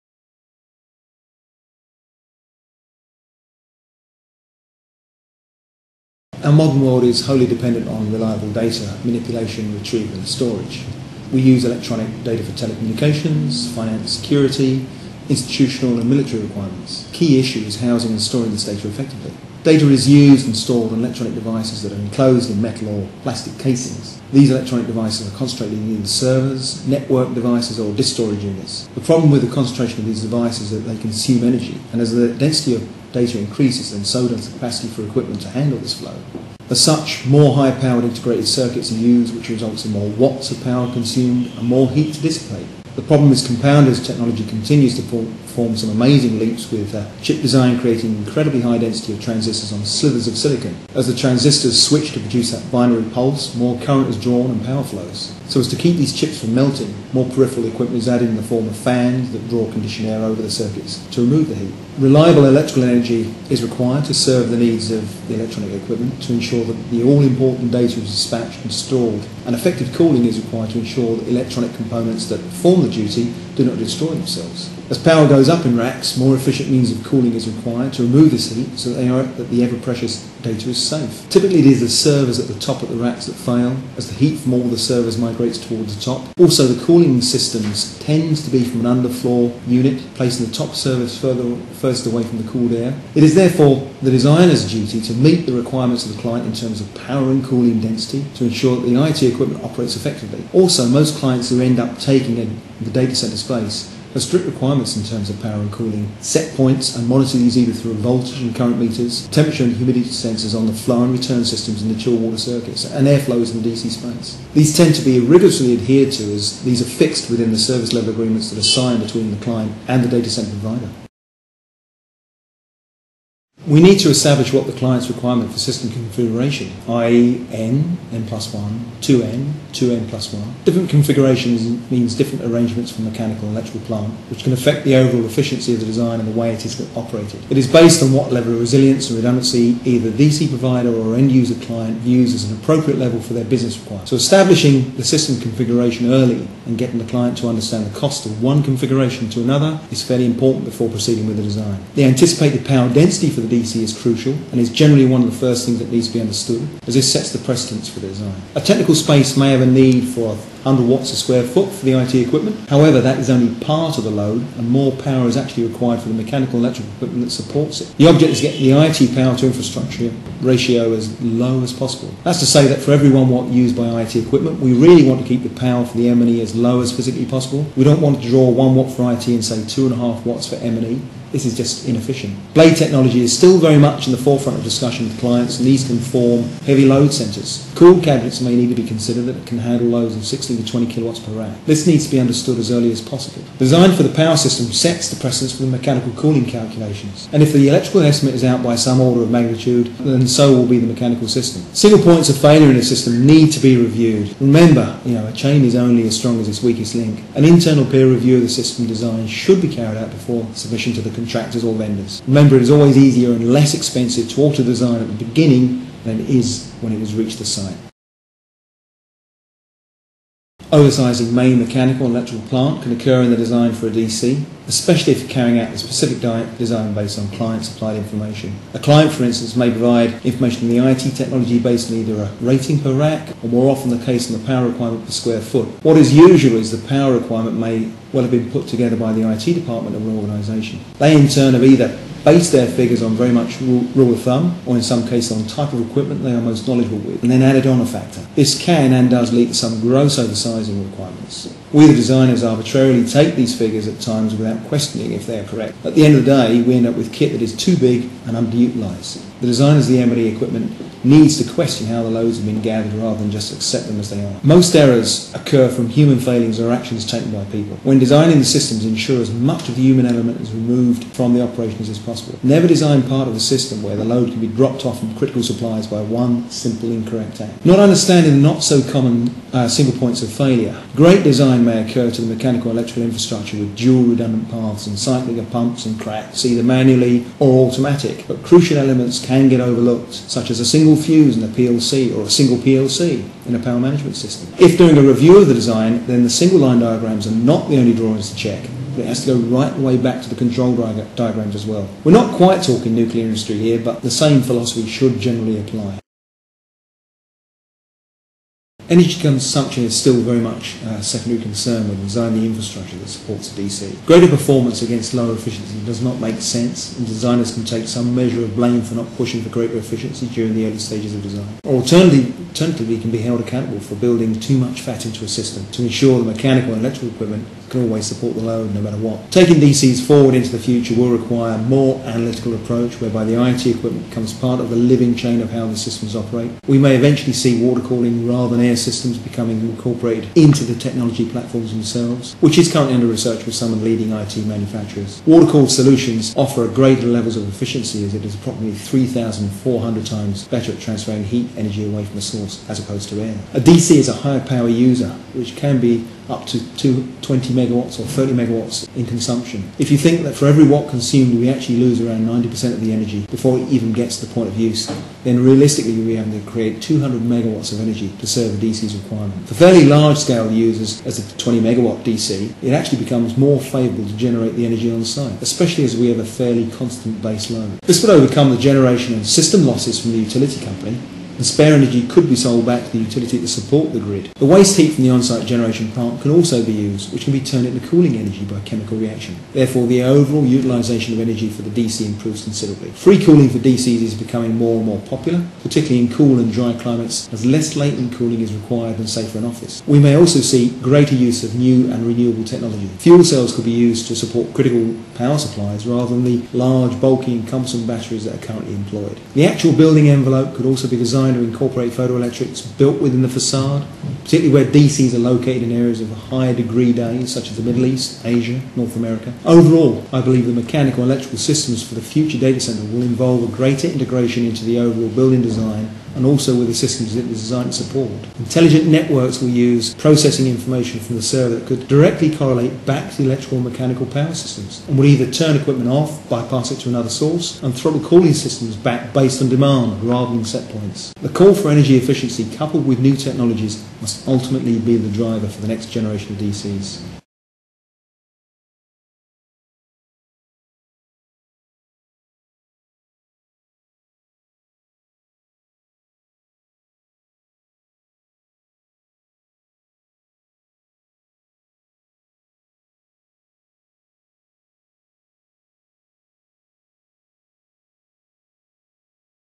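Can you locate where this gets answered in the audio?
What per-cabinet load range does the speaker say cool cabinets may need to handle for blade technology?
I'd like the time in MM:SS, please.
03:10.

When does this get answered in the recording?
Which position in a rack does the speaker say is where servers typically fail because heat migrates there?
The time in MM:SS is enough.
01:22.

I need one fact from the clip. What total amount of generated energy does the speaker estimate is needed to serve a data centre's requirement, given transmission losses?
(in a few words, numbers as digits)
200 megawatts.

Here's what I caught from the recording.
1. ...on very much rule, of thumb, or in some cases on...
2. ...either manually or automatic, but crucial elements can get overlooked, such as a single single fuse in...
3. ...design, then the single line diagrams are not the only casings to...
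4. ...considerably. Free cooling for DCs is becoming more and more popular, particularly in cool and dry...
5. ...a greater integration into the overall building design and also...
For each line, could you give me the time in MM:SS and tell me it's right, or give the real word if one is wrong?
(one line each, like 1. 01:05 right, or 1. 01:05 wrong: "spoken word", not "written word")
1. 04:03 right
2. 04:46 right
3. 04:55 wrong: "drawings", not "casings"
4. 06:32 right
5. 07:03 right.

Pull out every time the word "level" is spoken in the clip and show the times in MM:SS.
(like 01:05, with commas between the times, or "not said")
01:57, 02:18, 02:22, 05:47.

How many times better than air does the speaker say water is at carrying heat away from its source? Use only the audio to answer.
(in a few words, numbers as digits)
3,400.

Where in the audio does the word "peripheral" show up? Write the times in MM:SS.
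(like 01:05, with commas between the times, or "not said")
00:57.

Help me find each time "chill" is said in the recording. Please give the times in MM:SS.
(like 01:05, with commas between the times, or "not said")
01:51.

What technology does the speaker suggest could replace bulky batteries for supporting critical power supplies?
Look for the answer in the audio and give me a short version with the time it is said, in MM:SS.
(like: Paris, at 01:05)
Fuel cells, at 06:42.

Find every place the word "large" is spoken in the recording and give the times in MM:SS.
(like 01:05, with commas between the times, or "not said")
06:09, 06:46.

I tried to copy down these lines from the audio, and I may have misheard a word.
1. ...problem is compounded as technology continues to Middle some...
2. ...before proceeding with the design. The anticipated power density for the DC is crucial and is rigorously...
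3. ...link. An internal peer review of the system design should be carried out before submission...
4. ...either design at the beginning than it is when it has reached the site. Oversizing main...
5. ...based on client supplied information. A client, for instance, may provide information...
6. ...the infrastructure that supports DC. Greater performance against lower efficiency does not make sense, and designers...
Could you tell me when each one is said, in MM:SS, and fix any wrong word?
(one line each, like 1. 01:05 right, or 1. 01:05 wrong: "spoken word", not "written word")
1. 00:43 wrong: "Form", not "Middle"
2. 02:30 wrong: "generally", not "rigorously"
3. 03:26 right
4. 03:34 wrong: "alter", not "either"
5. 03:46 right
6. 05:12 right.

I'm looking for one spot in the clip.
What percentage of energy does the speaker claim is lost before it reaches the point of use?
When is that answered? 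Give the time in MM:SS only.
06:02.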